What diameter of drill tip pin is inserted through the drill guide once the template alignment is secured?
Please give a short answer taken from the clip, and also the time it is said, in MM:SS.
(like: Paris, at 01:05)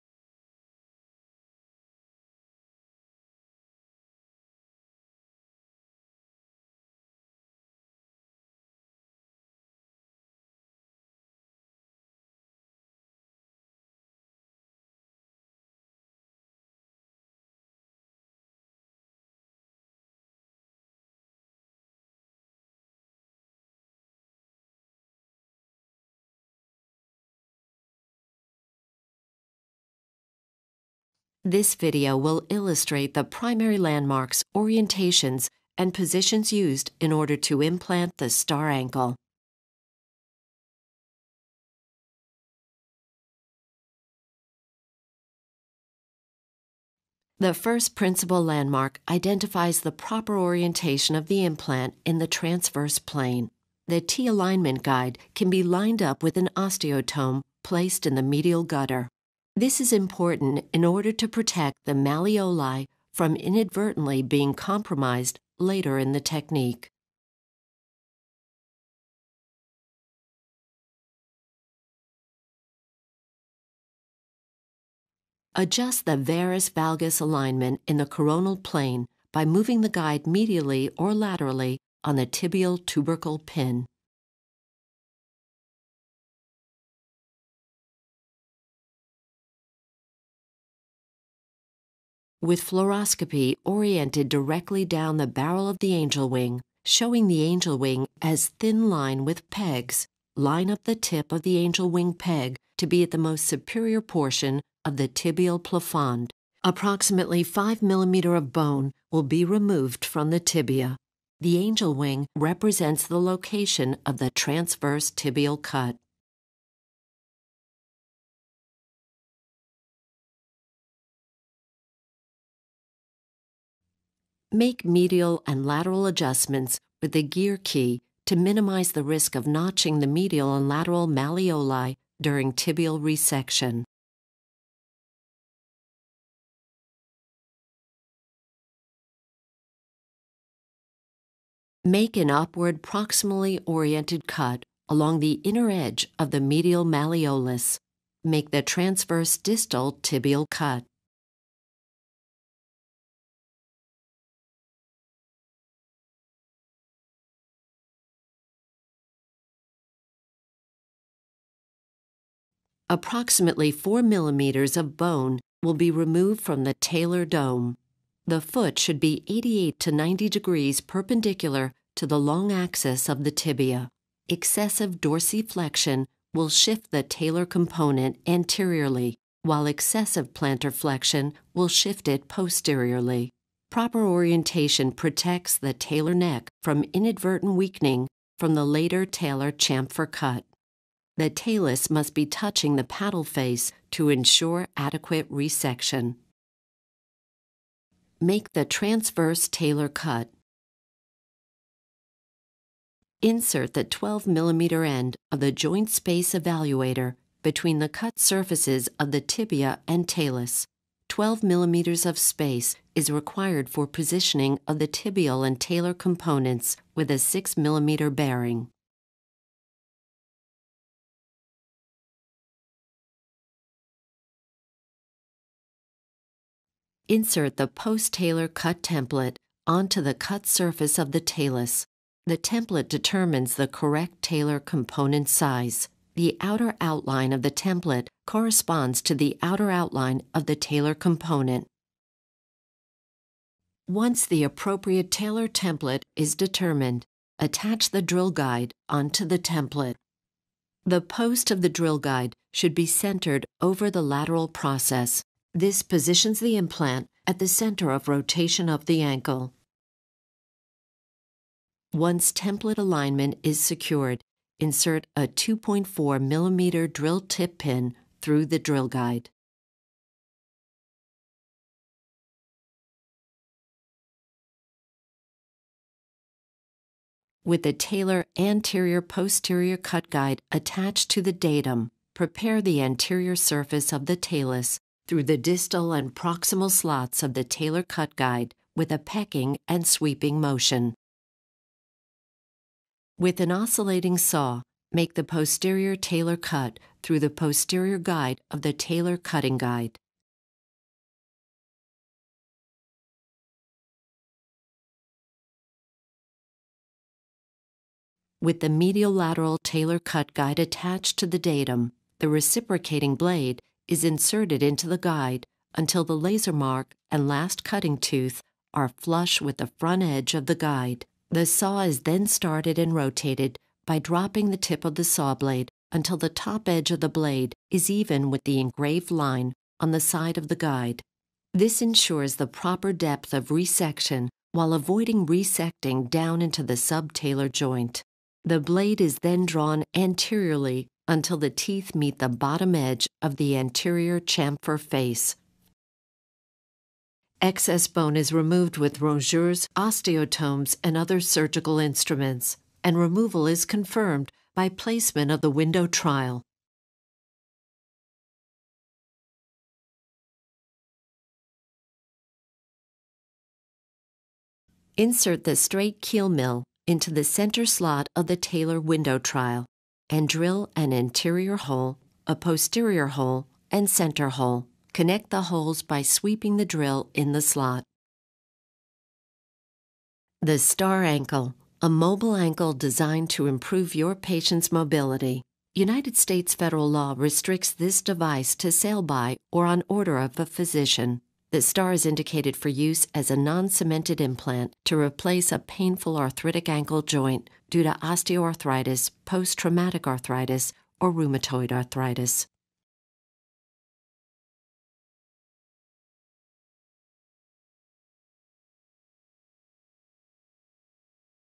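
2.4 millimeters, at 04:25.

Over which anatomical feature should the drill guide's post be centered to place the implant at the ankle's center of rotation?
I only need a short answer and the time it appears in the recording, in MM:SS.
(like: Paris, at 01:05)
lateral process, at 04:14.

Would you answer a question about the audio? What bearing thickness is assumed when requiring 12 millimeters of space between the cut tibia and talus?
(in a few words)
6 millimeters.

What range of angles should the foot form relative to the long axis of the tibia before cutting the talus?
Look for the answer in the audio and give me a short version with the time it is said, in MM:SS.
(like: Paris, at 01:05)
88 to 90 degrees, at 02:49.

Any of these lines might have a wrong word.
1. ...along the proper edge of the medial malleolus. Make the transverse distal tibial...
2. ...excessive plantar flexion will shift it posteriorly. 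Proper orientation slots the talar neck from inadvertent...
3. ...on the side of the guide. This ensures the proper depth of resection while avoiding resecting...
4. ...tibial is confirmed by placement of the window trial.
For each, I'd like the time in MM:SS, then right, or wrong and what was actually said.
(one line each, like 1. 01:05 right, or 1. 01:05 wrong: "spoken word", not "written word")
1. 02:24 wrong: "inner", not "proper"
2. 02:59 wrong: "protects", not "slots"
3. 05:29 right
4. 05:52 wrong: "removal", not "tibial".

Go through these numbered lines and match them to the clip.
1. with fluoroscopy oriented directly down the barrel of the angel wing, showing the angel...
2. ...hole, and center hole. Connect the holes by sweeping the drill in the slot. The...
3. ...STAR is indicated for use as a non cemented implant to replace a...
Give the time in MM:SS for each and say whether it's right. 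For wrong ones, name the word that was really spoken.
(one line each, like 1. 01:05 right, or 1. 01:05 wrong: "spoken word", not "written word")
1. 01:32 right
2. 06:13 right
3. 06:31 right.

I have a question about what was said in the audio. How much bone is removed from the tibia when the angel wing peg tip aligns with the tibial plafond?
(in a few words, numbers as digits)
5 millimeters.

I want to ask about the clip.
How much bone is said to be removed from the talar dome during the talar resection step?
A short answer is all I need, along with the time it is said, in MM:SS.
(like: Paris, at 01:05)
4 millimeters, at 02:43.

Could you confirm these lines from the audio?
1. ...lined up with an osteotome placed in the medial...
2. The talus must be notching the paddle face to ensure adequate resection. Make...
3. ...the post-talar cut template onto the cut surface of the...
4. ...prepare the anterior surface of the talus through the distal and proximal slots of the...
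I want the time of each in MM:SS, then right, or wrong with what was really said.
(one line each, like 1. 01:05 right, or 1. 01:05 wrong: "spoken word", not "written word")
1. 00:55 right
2. 03:11 wrong: "touching", not "notching"
3. 03:47 right
4. 04:42 right.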